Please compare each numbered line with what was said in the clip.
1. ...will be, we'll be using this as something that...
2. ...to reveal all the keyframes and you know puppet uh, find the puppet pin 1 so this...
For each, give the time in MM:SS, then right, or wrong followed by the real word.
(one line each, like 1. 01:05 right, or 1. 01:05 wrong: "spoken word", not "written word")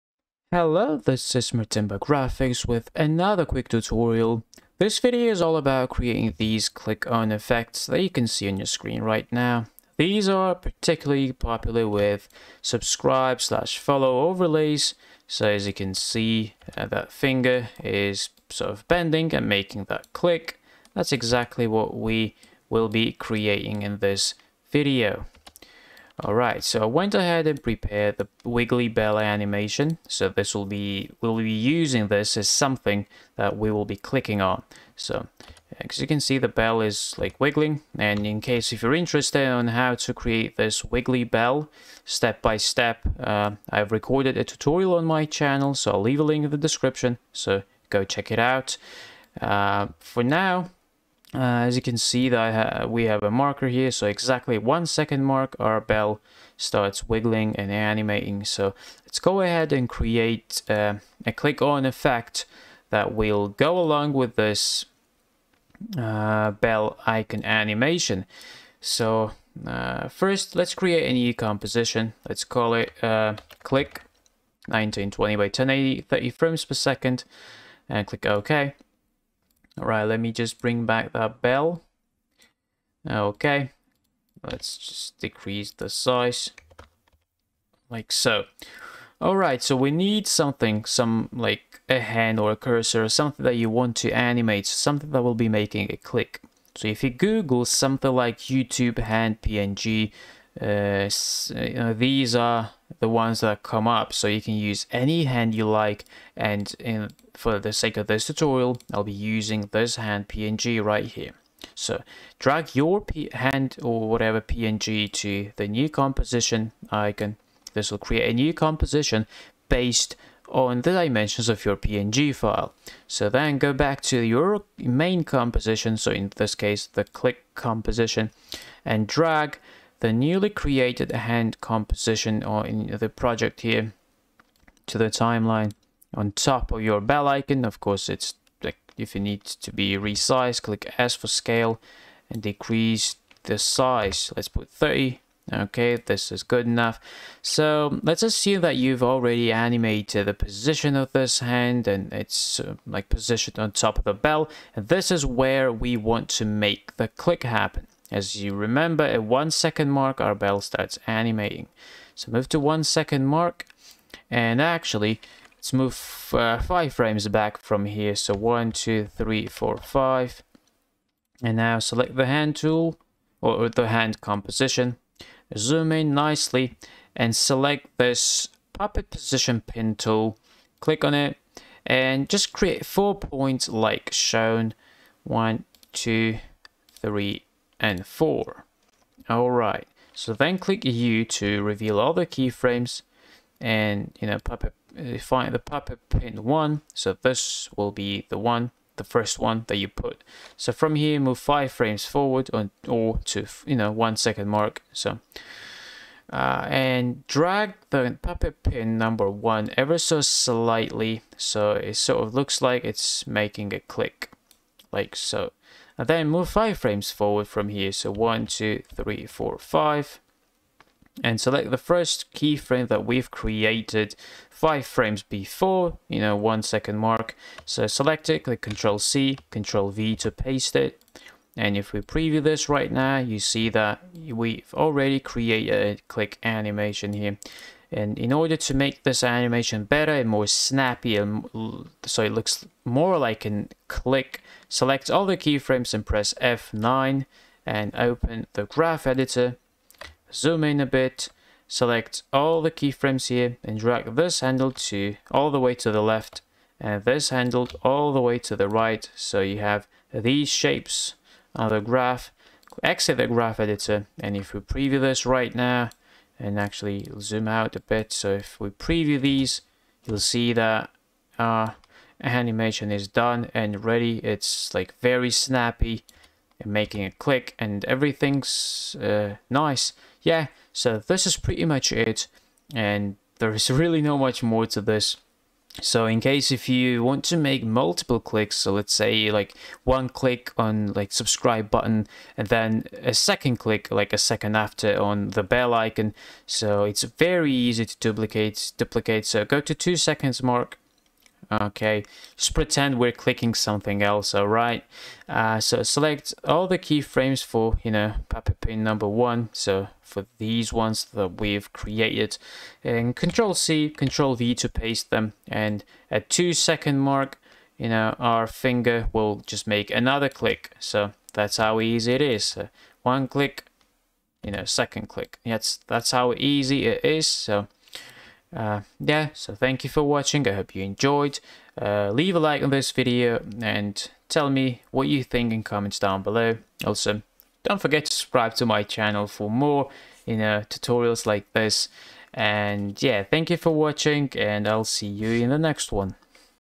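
1. 00:30 right
2. 03:11 right.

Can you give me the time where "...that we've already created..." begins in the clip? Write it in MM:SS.
03:53.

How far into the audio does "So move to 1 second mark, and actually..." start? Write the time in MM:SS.
02:42.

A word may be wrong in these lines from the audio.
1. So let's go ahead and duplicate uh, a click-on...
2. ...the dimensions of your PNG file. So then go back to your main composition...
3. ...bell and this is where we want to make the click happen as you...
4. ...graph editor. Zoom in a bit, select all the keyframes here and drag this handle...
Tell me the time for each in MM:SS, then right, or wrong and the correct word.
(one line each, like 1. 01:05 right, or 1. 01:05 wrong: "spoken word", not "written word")
1. 00:58 wrong: "create", not "duplicate"
2. 02:00 right
3. 02:34 right
4. 04:08 right.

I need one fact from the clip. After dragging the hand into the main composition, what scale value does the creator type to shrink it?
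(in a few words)
30.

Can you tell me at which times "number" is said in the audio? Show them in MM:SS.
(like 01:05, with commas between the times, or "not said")
03:28, 05:08.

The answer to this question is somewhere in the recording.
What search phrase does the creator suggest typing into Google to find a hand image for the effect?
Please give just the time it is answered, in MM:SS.
01:38.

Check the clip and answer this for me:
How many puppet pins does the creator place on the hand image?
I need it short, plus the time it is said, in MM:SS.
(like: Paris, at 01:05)
4, at 03:02.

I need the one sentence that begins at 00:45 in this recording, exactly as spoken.
So I'll leave a link in the description.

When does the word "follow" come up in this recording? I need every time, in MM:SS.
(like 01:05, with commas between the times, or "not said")
00:13.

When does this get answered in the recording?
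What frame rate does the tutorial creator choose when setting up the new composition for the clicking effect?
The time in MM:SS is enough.
01:16.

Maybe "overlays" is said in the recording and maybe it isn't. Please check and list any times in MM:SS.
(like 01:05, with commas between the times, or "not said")
00:14.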